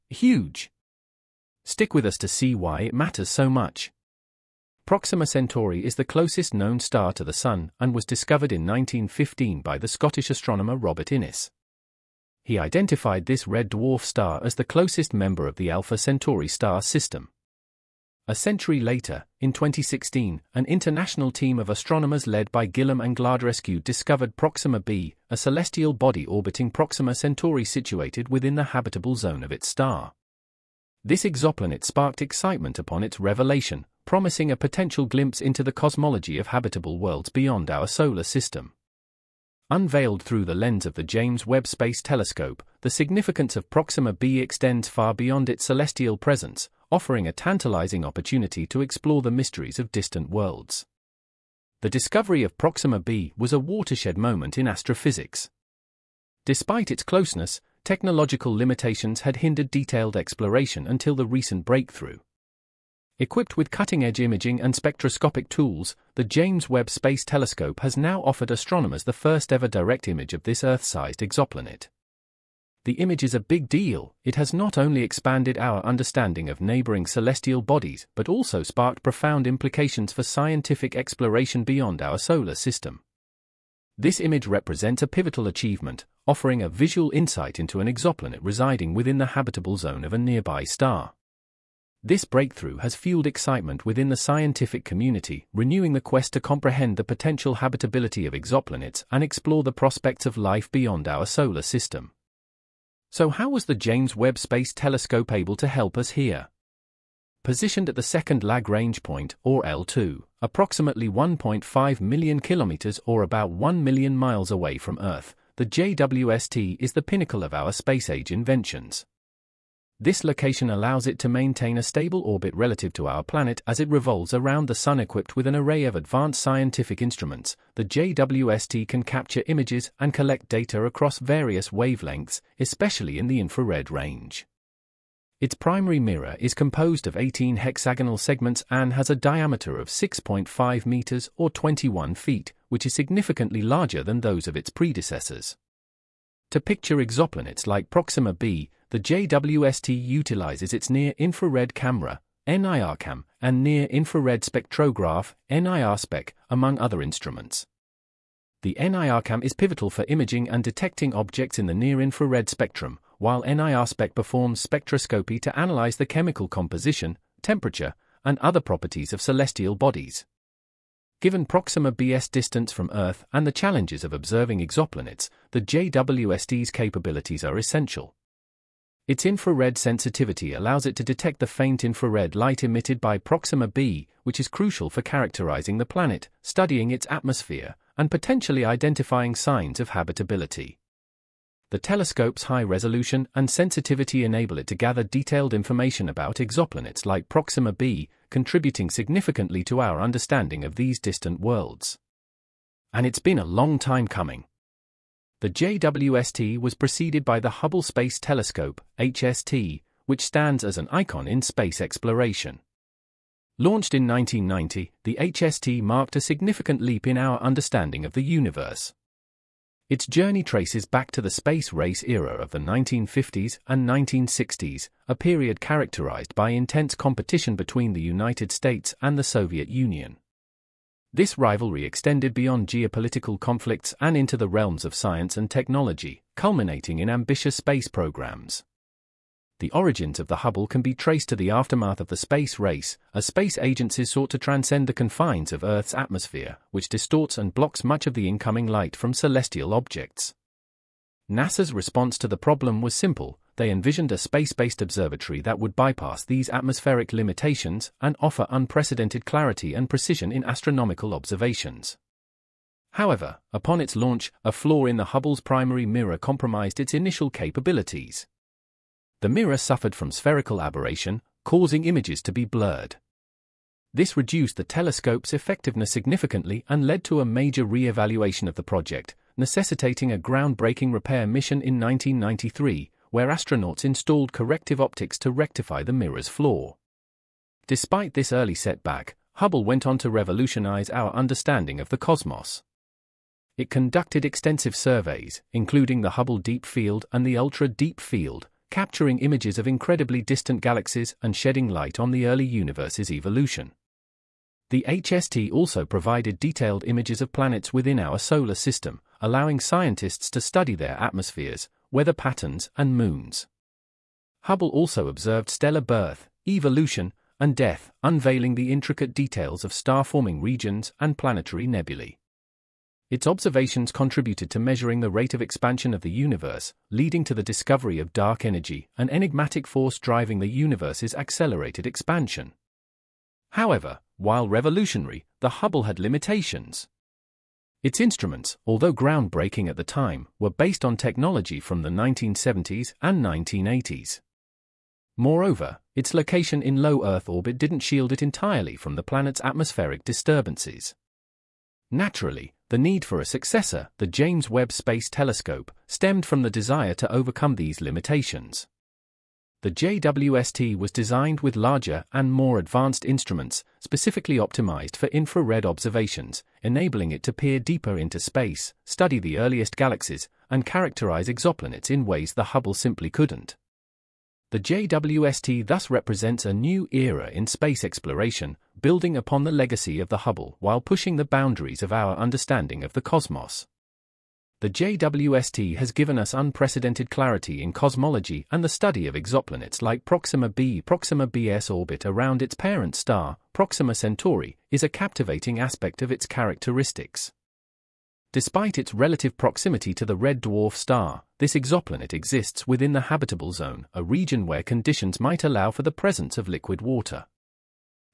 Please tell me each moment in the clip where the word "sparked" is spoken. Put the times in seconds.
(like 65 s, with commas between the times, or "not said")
31 s, 78 s.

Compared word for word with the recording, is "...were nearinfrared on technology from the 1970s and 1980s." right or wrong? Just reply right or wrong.
wrong.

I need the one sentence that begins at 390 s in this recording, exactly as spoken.
Proxima b's orbit around its parent star, Proxima Centauri, is a captivating aspect of its characteristics.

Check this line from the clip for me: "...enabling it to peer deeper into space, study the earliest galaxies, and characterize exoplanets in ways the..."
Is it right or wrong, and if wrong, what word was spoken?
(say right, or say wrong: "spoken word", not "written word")
right.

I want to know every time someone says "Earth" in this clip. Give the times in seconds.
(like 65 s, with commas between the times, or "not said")
70 s, 115 s, 172 s, 245 s, 347 s.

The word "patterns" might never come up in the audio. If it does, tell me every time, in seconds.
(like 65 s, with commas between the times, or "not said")
312 s.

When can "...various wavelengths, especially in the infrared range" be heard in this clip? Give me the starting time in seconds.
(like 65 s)
131 s.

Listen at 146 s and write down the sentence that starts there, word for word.
To picture exoplanets like Proxima b, the JWST utilizes its near-infrared camera, NIRCam, and near-infrared spectrograph, NIRSPEC, among other instruments.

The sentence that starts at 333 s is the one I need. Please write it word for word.
However, while revolutionary, the Hubble had limitations.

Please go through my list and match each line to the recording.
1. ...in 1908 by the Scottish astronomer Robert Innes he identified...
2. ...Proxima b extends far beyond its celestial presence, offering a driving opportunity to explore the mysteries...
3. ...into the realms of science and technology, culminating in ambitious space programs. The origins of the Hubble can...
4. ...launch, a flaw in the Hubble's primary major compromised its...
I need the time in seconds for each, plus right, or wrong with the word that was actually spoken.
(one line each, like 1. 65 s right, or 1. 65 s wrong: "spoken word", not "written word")
1. 8 s wrong: "1915", not "1908"
2. 43 s wrong: "tantalizing", not "driving"
3. 234 s right
4. 263 s wrong: "mirror", not "major".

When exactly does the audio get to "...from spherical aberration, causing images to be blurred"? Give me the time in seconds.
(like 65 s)
269 s.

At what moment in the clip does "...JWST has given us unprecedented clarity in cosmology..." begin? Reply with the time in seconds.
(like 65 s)
384 s.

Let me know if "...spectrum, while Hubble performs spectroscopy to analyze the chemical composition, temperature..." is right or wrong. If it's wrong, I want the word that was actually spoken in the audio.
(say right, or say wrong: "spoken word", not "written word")
wrong: "NIRSPEC", not "Hubble".